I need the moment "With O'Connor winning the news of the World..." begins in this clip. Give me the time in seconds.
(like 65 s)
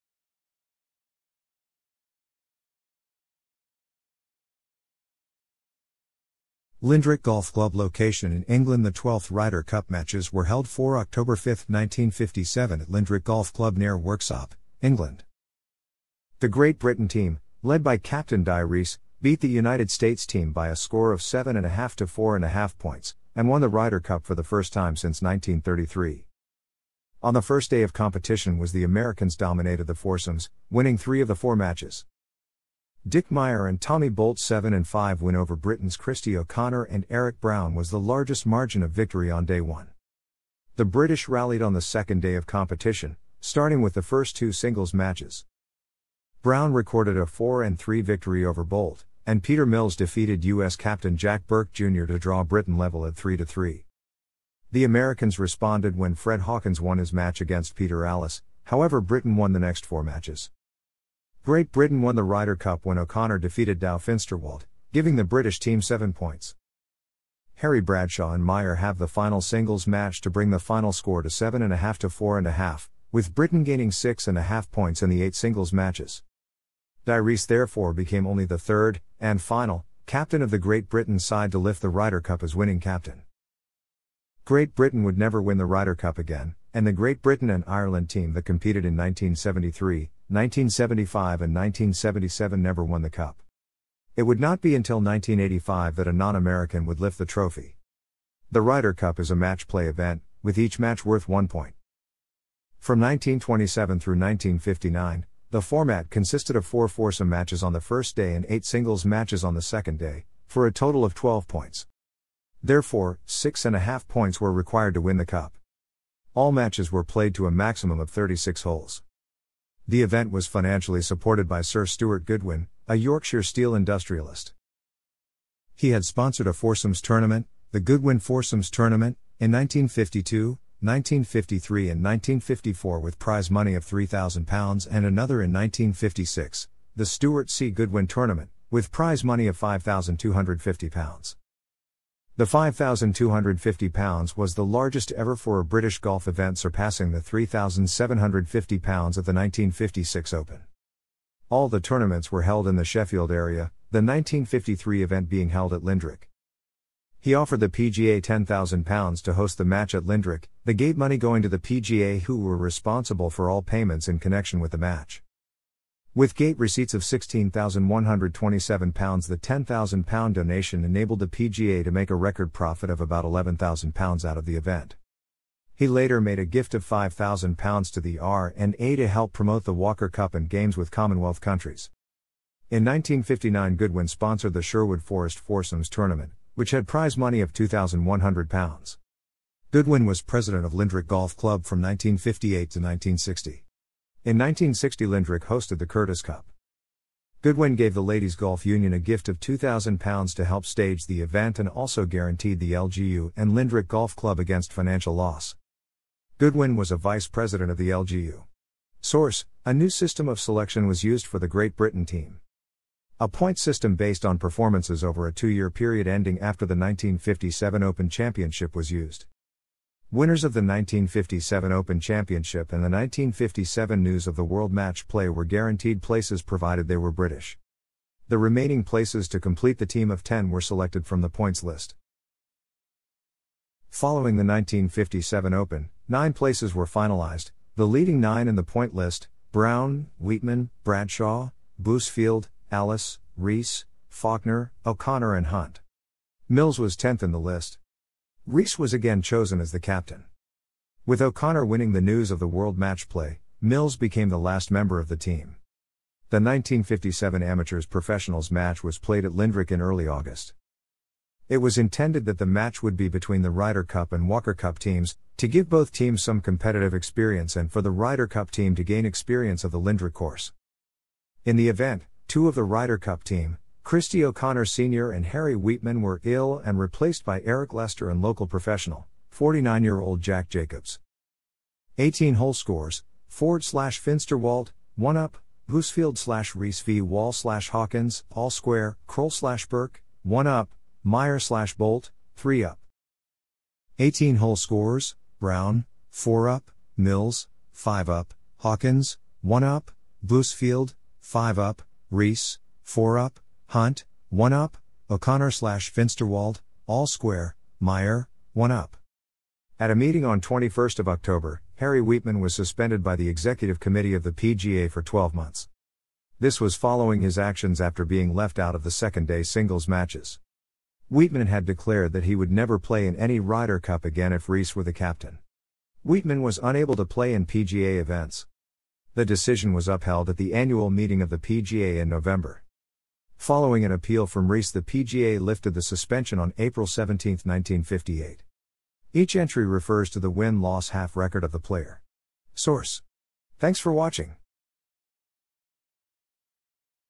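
251 s.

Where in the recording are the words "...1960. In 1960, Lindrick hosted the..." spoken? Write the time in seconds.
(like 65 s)
192 s.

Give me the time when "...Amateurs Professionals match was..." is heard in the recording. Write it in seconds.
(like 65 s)
257 s.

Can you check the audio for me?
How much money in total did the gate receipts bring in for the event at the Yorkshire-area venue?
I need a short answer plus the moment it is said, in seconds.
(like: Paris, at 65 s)
£16,127, at 167 s.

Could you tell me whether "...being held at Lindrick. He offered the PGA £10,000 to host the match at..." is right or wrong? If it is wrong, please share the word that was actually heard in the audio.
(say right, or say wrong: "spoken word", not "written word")
right.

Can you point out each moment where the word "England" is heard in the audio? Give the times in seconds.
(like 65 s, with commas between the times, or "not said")
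8 s, 14 s.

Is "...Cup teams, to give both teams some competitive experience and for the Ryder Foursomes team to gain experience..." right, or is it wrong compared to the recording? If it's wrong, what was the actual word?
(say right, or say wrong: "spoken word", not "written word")
wrong: "Cup", not "Foursomes".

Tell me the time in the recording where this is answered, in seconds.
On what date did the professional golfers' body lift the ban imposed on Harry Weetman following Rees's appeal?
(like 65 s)
336 s.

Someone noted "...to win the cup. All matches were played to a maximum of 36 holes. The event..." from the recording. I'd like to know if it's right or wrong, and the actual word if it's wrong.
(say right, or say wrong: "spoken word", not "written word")
right.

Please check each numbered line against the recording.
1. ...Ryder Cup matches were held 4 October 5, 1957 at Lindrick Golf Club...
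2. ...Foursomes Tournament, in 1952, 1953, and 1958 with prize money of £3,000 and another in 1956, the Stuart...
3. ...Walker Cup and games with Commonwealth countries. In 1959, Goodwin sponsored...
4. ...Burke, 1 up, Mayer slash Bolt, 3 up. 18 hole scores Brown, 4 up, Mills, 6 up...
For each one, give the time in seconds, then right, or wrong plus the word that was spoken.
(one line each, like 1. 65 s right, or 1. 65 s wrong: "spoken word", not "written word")
1. 9 s right
2. 128 s wrong: "1954", not "1958"
3. 179 s right
4. 289 s wrong: "5", not "6".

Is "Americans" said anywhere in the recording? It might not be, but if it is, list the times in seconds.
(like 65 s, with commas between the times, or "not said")
28 s, 54 s, 96 s.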